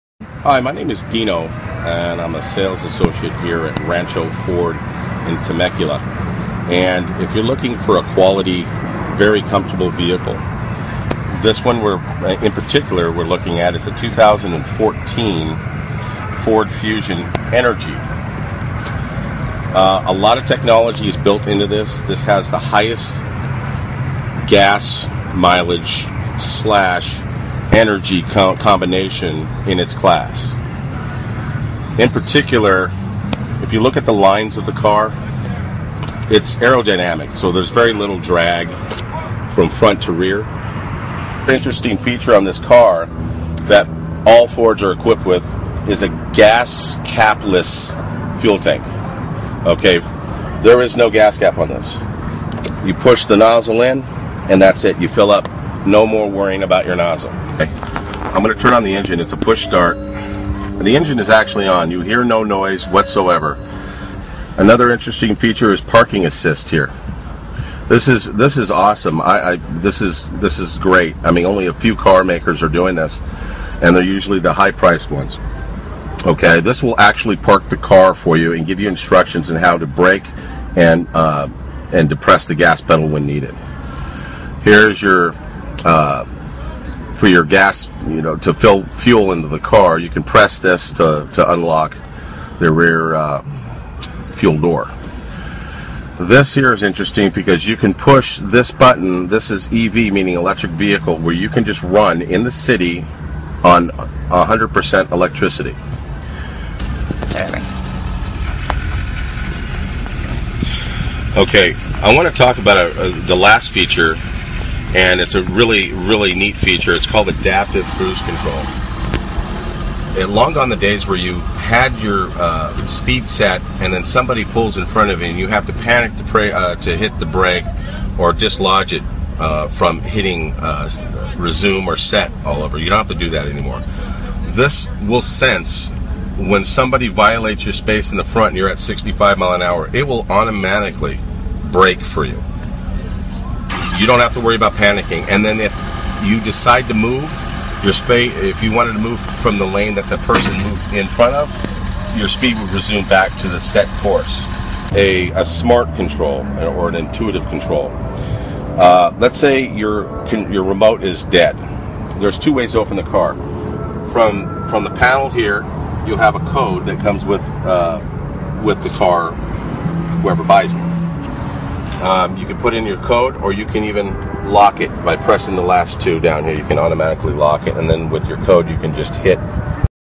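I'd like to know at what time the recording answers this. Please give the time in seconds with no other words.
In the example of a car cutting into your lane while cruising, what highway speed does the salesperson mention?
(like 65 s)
138 s.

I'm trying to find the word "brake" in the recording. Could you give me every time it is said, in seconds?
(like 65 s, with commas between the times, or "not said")
79 s, 127 s, 141 s.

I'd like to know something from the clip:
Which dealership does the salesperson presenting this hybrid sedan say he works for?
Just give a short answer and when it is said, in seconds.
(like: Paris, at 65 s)
Rancho Ford, at 3 s.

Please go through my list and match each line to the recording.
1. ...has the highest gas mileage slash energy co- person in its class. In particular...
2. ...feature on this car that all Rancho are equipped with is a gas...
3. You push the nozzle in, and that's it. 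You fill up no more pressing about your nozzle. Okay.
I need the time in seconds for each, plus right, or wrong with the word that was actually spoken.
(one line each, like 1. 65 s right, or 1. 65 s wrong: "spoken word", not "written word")
1. 22 s wrong: "combination", not "person"
2. 41 s wrong: "Fords", not "Rancho"
3. 52 s wrong: "worrying", not "pressing".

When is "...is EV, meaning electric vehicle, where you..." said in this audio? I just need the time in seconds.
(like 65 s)
99 s.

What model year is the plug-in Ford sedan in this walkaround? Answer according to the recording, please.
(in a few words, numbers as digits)
2014.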